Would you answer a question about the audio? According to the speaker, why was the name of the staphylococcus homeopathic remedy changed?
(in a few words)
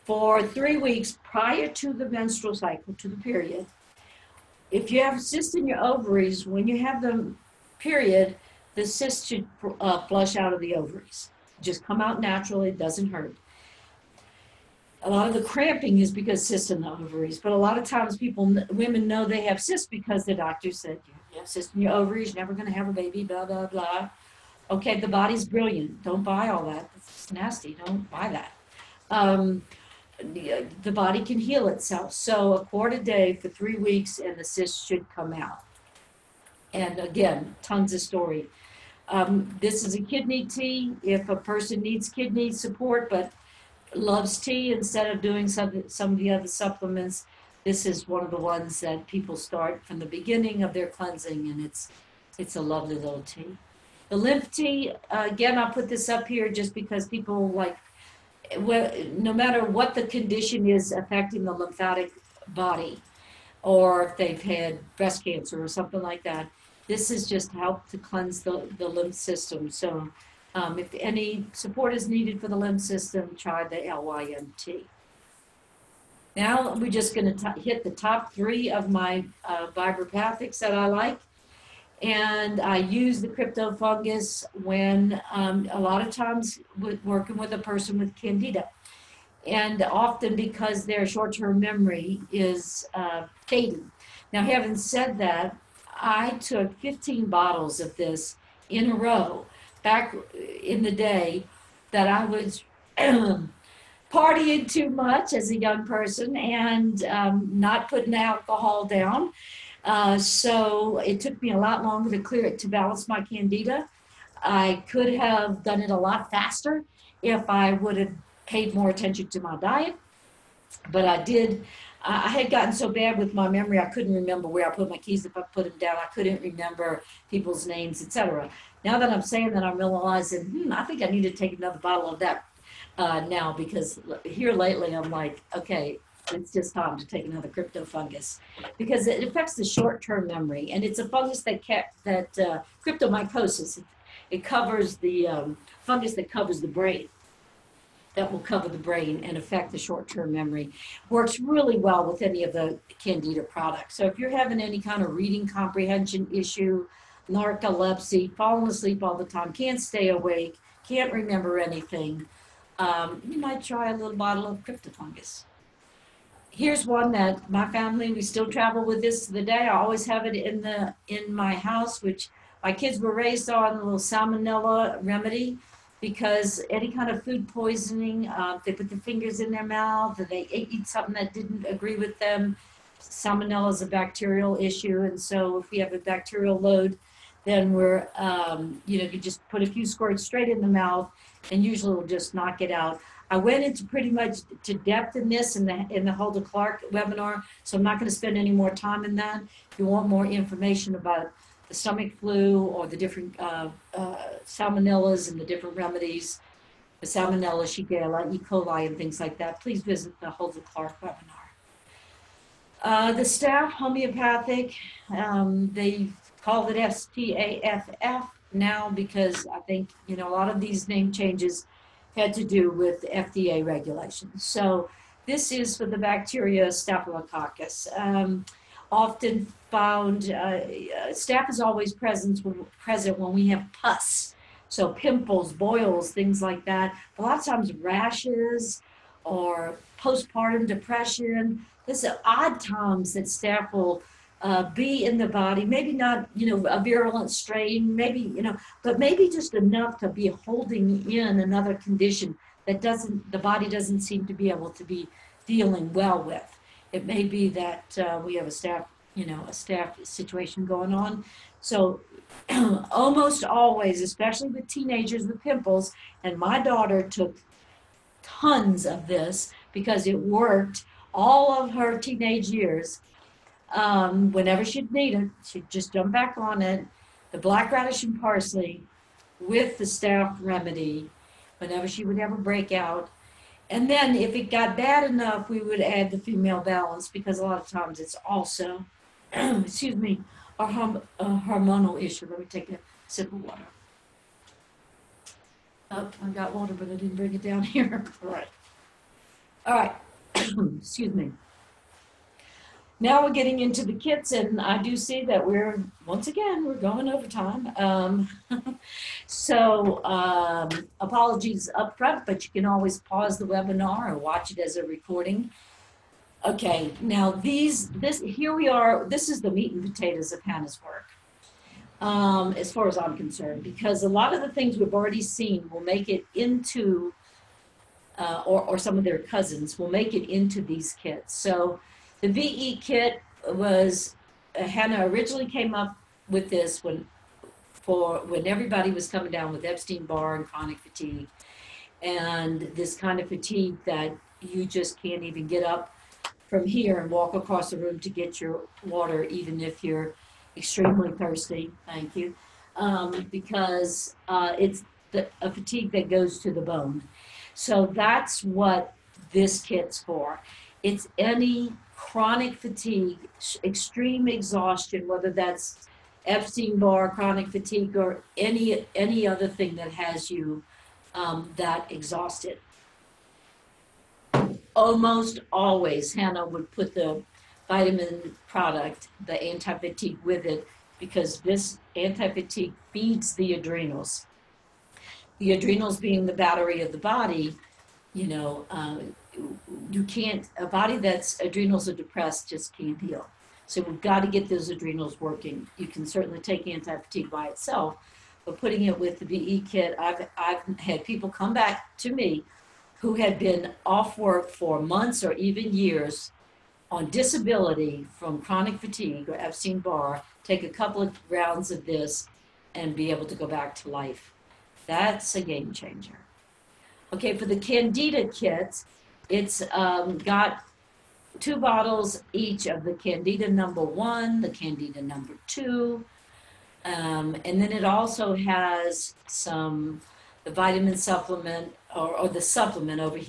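FDA regulations.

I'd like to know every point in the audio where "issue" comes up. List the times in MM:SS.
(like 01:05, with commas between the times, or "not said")
02:36, 03:04, 04:52.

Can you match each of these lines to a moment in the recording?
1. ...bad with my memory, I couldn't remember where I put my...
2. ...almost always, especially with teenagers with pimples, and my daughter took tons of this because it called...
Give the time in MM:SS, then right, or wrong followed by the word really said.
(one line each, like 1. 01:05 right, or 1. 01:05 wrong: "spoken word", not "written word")
1. 02:02 right
2. 04:22 wrong: "worked", not "called".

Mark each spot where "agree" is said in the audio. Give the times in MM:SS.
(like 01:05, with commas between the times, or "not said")
03:01.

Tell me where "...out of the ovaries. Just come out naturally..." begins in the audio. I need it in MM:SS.
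00:10.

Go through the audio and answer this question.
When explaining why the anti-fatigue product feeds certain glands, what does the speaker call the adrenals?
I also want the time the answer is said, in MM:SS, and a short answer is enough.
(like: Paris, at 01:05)
the battery of the body, at 06:26.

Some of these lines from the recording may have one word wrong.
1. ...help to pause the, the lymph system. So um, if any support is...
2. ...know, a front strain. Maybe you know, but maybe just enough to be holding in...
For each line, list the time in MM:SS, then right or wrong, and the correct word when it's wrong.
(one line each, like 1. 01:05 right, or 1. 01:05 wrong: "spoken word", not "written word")
1. 01:07 wrong: "cleanse", not "pause"
2. 04:06 wrong: "virulent", not "front".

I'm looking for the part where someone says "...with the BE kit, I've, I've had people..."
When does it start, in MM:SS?
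06:38.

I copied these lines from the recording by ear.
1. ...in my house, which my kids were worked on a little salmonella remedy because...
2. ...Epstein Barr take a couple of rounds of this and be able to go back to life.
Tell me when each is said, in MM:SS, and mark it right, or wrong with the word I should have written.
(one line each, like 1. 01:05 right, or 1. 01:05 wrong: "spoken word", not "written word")
1. 02:51 wrong: "raised", not "worked"
2. 06:49 right.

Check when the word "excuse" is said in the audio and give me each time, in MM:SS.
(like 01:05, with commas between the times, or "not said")
04:49, 05:00.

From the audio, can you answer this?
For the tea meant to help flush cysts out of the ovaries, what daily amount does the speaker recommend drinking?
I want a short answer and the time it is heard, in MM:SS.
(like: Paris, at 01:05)
a quart, at 00:32.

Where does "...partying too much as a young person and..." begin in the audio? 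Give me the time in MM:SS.
01:44.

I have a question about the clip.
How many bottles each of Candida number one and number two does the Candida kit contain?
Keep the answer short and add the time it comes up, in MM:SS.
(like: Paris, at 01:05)
2, at 07:01.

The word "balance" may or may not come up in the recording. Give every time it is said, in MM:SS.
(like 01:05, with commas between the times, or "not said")
01:52, 04:46.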